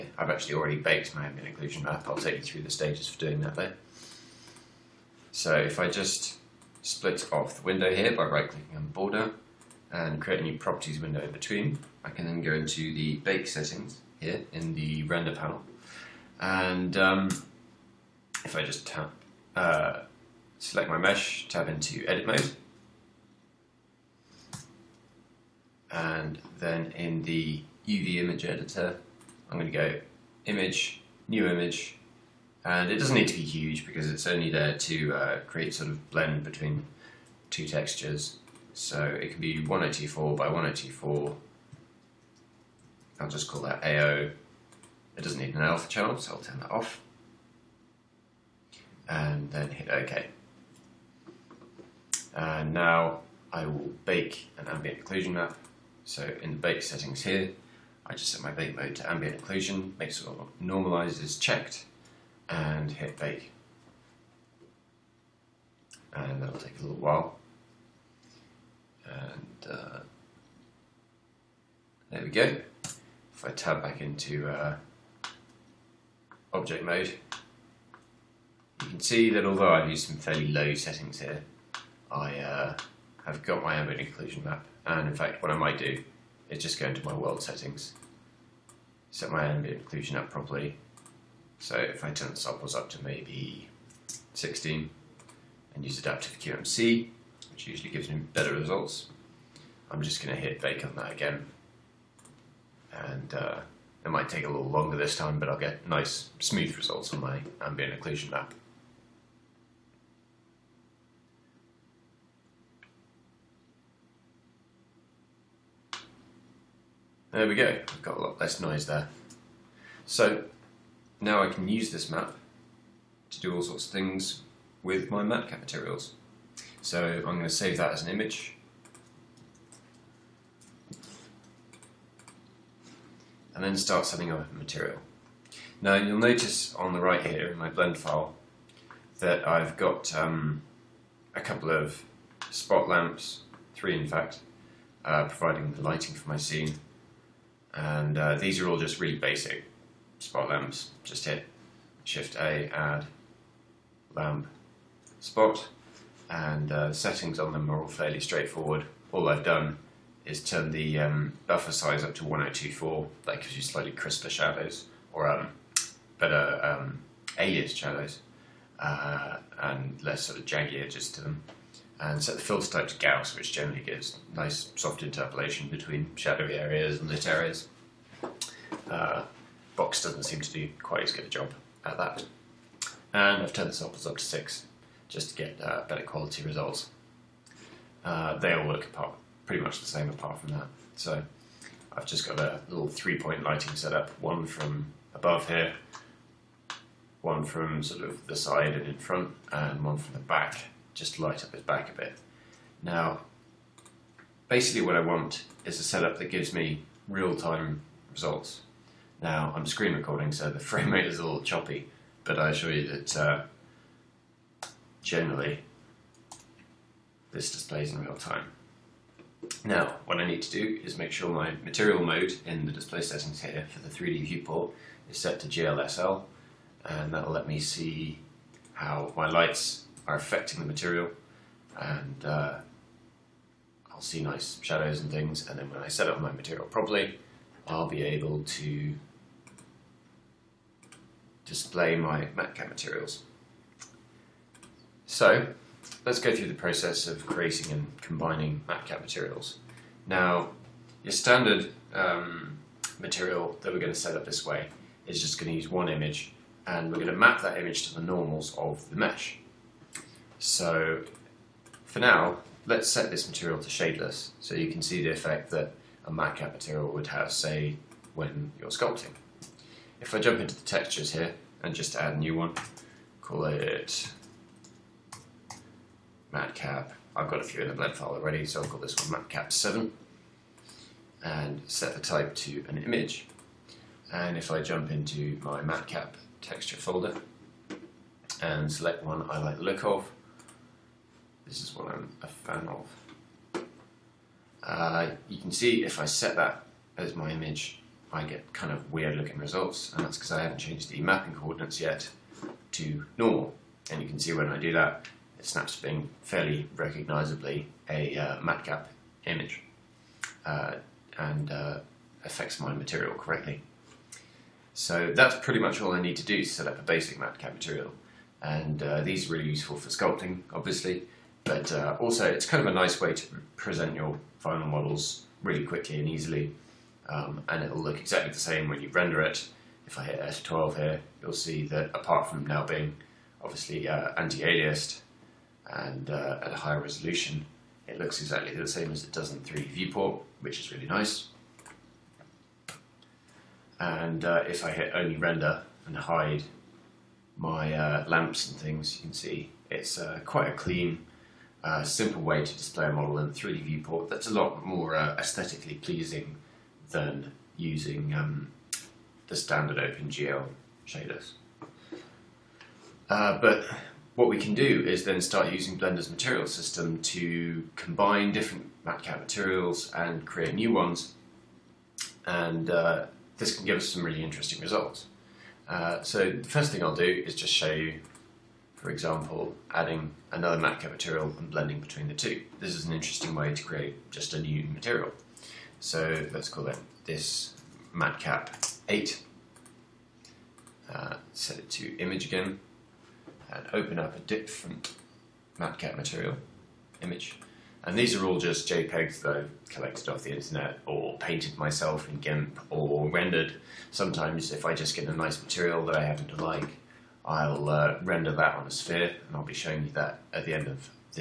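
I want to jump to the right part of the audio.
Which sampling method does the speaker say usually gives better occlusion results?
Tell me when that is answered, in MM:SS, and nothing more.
01:35.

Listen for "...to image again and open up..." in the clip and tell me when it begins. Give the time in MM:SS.
06:31.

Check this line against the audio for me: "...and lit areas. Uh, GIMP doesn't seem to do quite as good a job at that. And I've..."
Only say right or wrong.
wrong.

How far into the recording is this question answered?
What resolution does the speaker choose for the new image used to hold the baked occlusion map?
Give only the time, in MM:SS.
00:39.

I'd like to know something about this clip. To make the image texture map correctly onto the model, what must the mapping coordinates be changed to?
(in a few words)
normal.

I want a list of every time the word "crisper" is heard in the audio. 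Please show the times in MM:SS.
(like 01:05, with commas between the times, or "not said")
02:43.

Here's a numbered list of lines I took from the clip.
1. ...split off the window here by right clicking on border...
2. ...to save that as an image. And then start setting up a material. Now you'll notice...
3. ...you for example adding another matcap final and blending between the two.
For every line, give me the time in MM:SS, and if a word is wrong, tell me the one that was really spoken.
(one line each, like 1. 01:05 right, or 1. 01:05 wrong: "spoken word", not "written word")
1. 00:06 right
2. 02:07 right
3. 06:17 wrong: "material", not "final".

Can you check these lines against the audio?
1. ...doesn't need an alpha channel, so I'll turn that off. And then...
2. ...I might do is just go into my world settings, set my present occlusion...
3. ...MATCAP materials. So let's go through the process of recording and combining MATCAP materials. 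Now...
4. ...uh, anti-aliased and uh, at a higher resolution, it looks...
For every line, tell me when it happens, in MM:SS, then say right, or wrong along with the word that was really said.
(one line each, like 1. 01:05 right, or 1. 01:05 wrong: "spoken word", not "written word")
1. 00:45 right
2. 01:25 wrong: "ambient", not "present"
3. 04:02 wrong: "creating", not "recording"
4. 05:33 right.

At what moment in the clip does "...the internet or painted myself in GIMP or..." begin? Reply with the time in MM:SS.
06:40.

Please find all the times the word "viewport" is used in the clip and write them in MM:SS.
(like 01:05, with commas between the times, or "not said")
03:44, 05:39, 05:53.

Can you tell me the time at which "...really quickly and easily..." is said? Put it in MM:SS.
05:25.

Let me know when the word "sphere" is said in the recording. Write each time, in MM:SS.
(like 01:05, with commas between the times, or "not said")
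06:48.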